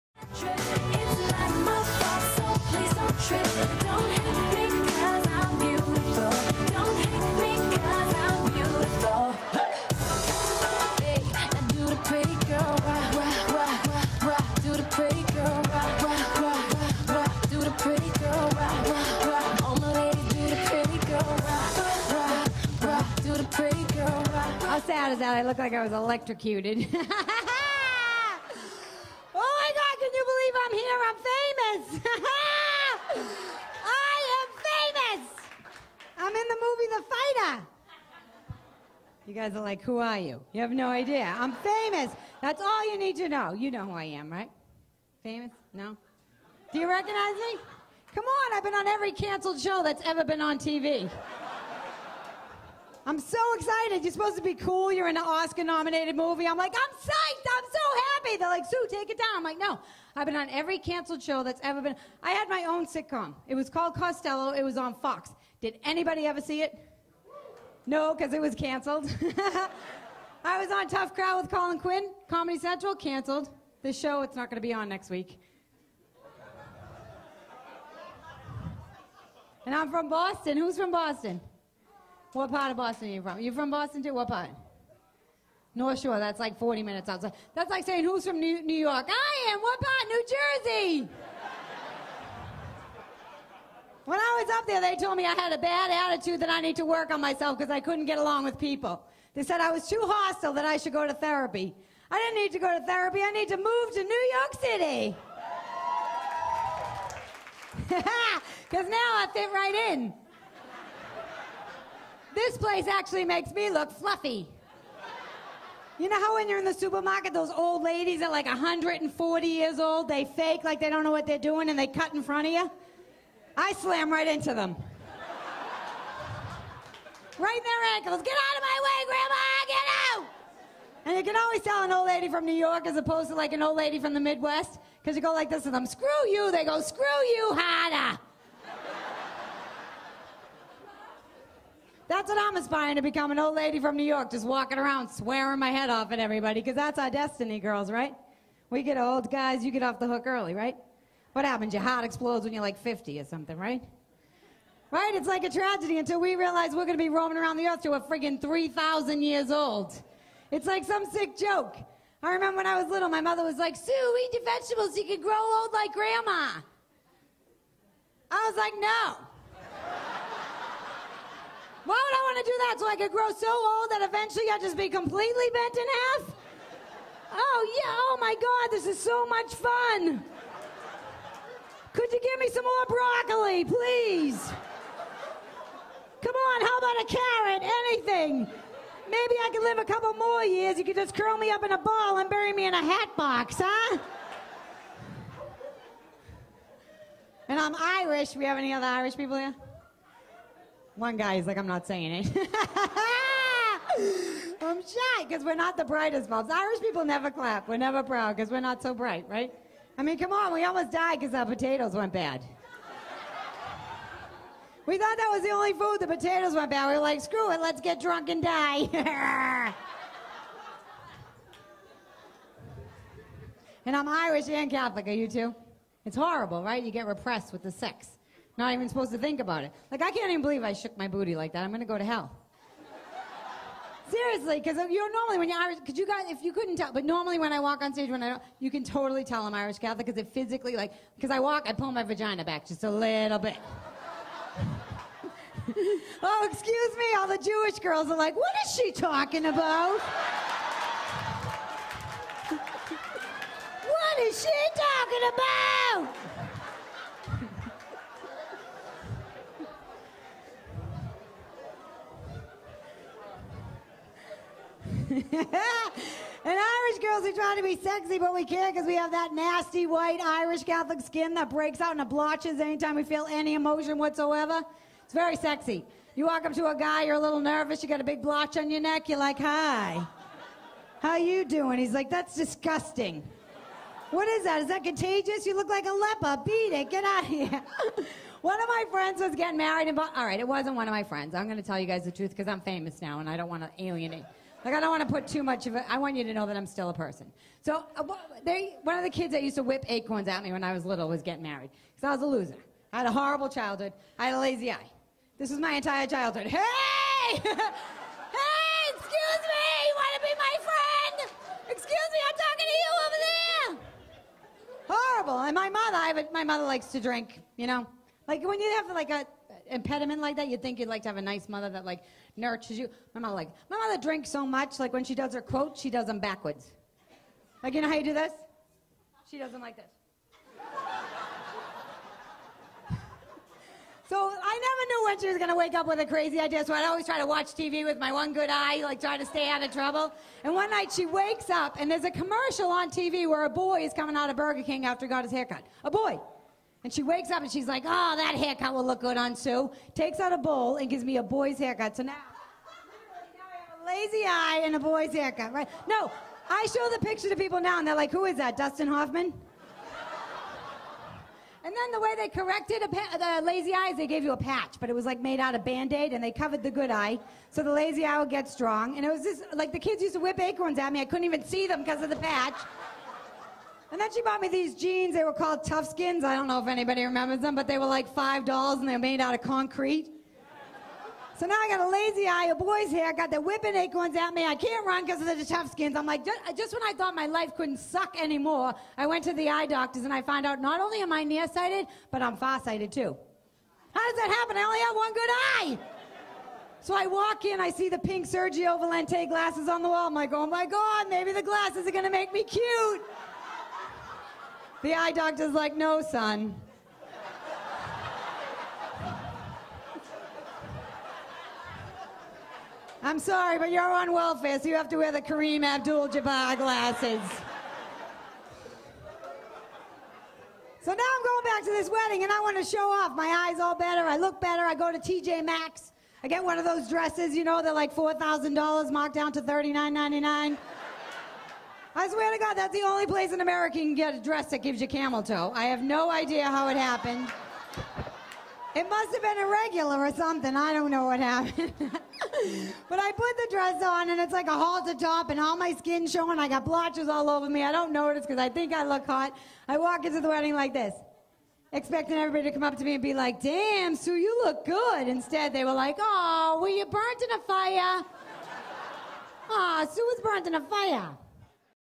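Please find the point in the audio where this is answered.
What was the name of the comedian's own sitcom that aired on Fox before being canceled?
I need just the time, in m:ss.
1:03.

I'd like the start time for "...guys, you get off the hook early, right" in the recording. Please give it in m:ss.
2:29.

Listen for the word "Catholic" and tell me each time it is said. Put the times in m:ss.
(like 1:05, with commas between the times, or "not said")
3:44, 3:59, 4:30.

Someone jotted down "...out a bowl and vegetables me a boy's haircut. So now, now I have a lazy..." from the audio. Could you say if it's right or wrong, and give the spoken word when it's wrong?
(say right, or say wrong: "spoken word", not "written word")
wrong: "gives", not "vegetables".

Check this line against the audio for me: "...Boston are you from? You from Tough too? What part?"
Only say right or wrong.
wrong.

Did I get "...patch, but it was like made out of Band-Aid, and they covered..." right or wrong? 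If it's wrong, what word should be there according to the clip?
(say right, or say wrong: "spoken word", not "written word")
right.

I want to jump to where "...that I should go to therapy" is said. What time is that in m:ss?
1:40.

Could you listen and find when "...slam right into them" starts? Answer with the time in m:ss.
2:03.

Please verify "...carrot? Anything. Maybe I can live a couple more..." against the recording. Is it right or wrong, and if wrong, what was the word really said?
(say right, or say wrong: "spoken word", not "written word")
right.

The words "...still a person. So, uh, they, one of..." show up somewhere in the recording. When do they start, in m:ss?
4:56.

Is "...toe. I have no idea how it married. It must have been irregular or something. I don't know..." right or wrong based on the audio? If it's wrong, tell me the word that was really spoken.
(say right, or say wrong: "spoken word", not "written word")
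wrong: "happened", not "married".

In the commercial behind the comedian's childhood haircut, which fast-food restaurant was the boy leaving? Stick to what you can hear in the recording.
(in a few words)
Burger King.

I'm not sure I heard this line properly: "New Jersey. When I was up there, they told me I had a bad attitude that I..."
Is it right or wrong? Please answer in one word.
right.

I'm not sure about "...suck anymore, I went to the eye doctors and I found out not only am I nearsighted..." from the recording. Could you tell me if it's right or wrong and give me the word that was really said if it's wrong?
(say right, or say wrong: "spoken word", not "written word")
right.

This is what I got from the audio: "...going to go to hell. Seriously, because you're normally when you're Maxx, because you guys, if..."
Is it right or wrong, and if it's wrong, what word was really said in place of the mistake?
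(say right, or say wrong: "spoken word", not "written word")
wrong: "Irish", not "Maxx".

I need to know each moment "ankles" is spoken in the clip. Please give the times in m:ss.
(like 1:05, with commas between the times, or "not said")
2:07.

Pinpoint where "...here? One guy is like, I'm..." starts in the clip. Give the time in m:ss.
3:19.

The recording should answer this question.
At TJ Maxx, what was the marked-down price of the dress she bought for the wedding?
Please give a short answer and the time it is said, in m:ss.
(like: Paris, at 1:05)
$39.99, at 7:09.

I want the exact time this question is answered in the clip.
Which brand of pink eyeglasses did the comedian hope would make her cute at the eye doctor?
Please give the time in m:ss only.
6:38.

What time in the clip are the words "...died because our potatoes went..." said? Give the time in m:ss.
3:30.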